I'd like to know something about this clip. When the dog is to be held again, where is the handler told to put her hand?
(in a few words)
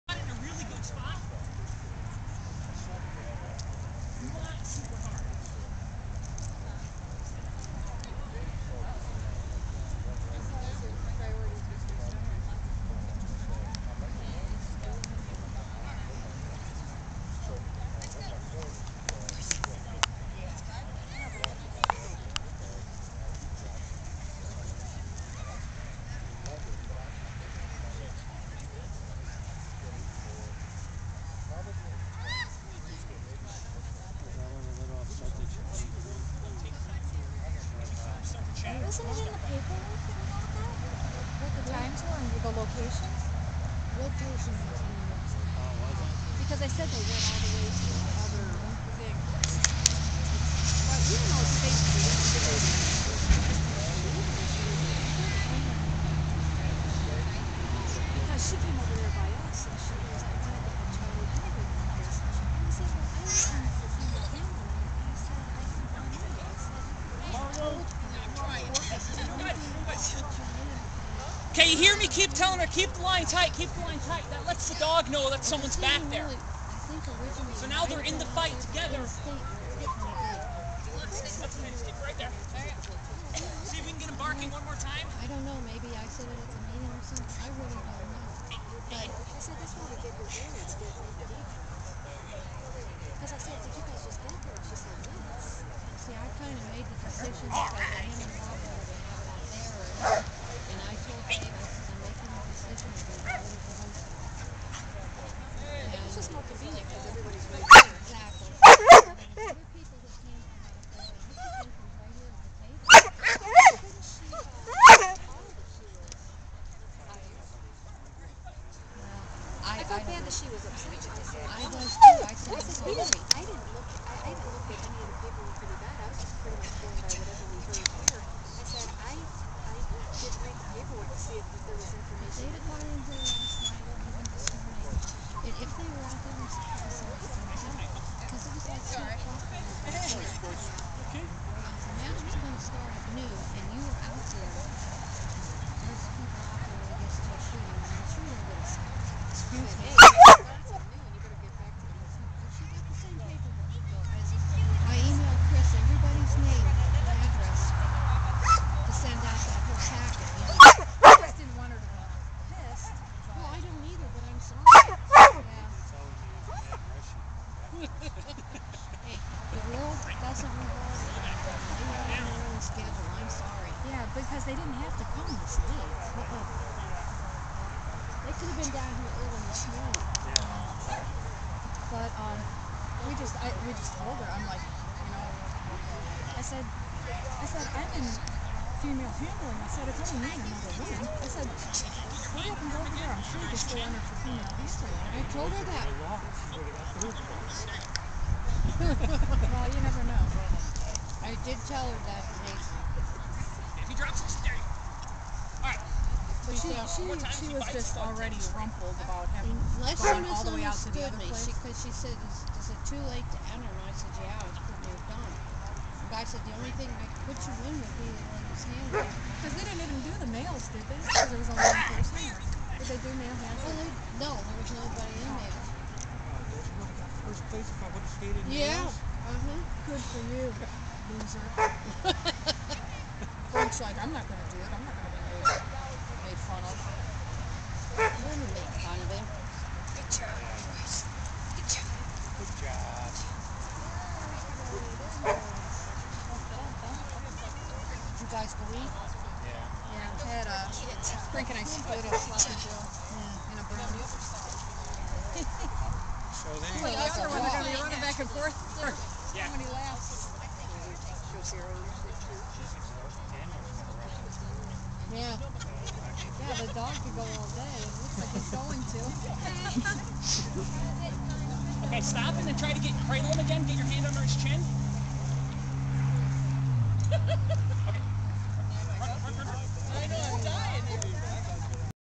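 under his chin.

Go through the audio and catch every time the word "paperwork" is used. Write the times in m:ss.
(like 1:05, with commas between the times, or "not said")
0:39, 2:05, 2:10.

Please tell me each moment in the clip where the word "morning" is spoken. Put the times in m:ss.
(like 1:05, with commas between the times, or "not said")
2:59.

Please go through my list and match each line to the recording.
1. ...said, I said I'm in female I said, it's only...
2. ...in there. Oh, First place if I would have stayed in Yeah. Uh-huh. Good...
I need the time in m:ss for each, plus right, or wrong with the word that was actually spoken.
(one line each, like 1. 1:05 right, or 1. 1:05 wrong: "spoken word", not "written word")
1. 3:06 right
2. 3:45 right.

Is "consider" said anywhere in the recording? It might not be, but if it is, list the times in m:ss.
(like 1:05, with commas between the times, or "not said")
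not said.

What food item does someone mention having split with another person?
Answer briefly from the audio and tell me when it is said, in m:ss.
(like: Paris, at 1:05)
sloppy joe, at 4:12.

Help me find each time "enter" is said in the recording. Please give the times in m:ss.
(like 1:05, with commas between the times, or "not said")
3:13, 3:33.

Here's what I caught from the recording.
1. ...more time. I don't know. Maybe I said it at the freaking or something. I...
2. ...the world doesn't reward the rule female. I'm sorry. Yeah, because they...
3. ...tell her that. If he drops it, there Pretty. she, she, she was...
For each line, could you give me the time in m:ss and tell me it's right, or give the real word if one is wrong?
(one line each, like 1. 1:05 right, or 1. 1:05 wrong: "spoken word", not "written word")
1. 1:24 wrong: "meeting", not "freaking"
2. 2:49 wrong: "schedule", not "female"
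3. 3:21 wrong: "Alright", not "Pretty".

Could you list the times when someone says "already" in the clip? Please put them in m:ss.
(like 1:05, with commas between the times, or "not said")
3:28.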